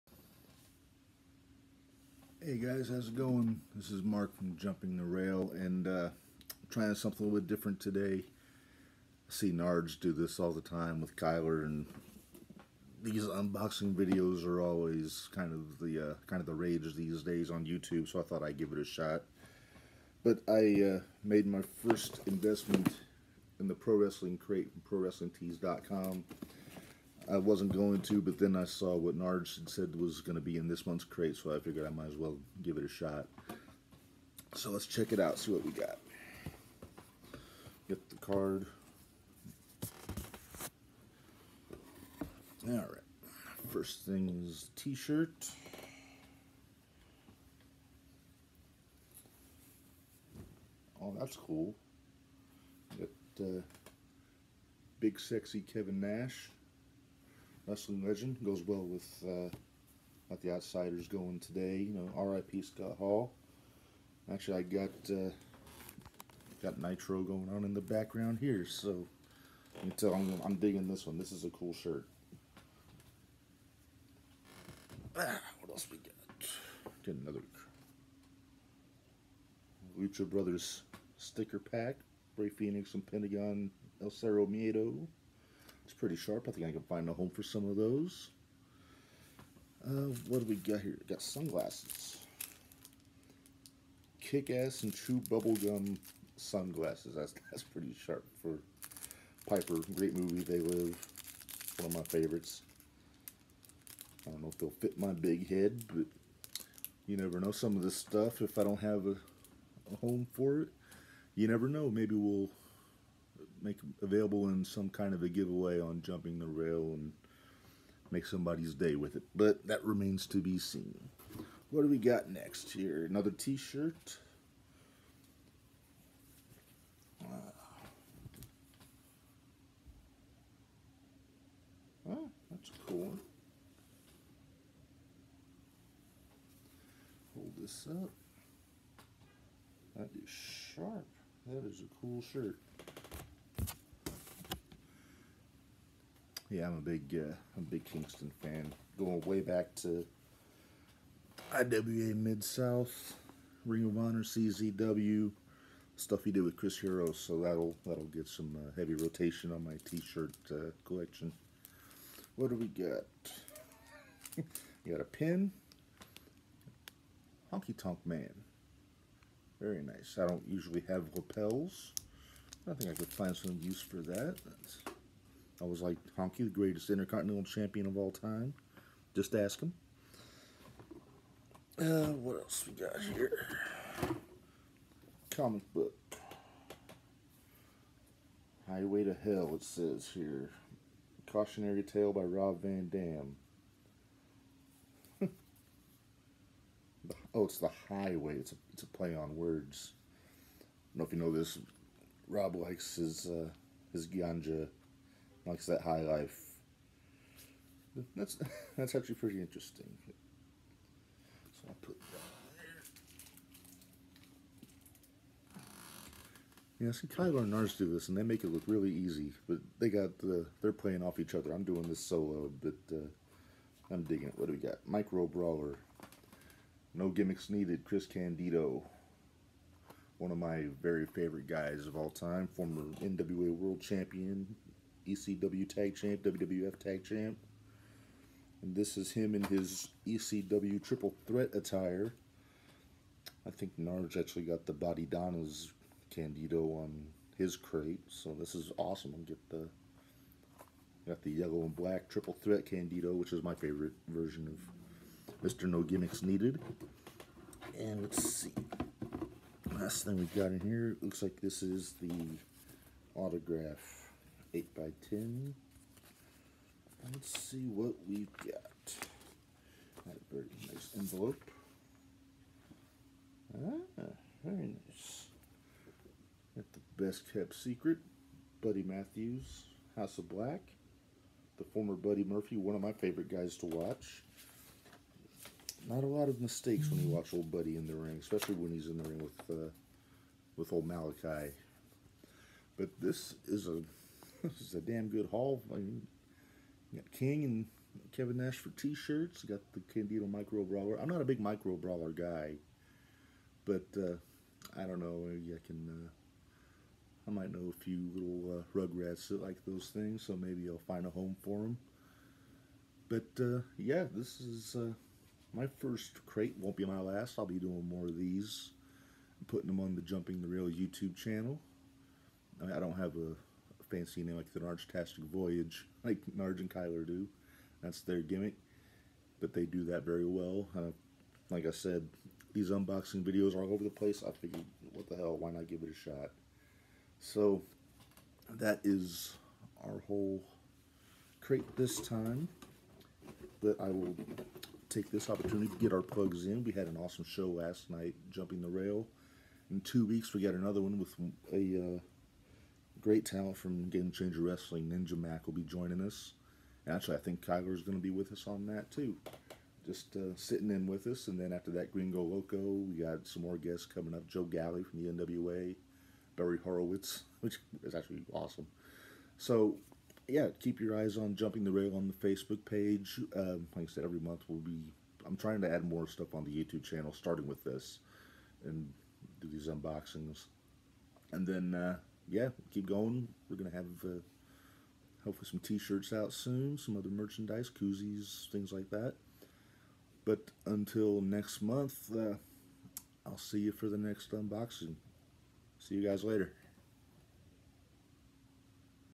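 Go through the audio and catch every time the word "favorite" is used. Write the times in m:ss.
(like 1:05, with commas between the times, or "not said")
1:42, 3:51, 4:13, 4:42.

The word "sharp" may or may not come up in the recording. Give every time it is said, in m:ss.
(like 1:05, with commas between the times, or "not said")
1:26, 1:38, 2:20.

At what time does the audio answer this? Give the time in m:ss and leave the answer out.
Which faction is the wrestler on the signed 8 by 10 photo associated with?
4:39.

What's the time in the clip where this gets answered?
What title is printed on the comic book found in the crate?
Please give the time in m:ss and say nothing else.
3:08.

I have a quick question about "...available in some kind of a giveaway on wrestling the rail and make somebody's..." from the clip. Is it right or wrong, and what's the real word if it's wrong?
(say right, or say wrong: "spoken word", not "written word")
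wrong: "jumping", not "wrestling".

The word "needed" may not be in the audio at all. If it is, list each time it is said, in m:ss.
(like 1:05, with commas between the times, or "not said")
3:47, 4:16.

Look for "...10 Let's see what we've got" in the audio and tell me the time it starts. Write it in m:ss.
4:25.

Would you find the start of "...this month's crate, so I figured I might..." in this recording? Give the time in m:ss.
0:30.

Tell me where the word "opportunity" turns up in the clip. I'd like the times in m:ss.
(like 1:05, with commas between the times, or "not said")
5:45.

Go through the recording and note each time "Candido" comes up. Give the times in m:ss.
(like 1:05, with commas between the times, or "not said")
3:48, 4:06, 4:12, 4:59.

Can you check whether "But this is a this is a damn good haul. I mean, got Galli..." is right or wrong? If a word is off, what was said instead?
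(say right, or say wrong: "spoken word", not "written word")
wrong: "King", not "Galli".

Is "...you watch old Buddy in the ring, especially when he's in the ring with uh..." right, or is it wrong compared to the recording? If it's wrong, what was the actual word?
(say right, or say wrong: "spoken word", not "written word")
right.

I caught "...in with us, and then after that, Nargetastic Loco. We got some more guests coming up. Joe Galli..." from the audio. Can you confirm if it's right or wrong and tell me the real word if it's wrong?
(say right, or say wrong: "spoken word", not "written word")
wrong: "Gringo", not "Nargetastic".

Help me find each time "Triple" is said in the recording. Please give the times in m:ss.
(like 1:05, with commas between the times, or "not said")
4:00, 4:12.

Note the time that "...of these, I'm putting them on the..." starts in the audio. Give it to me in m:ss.
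5:18.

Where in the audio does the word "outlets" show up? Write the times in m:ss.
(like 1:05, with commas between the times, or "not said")
not said.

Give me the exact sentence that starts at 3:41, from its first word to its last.
I'm doing this solo, but uh, I'm digging it.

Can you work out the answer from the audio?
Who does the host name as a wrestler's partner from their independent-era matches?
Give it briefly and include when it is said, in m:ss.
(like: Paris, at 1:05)
Chris Hero, at 2:36.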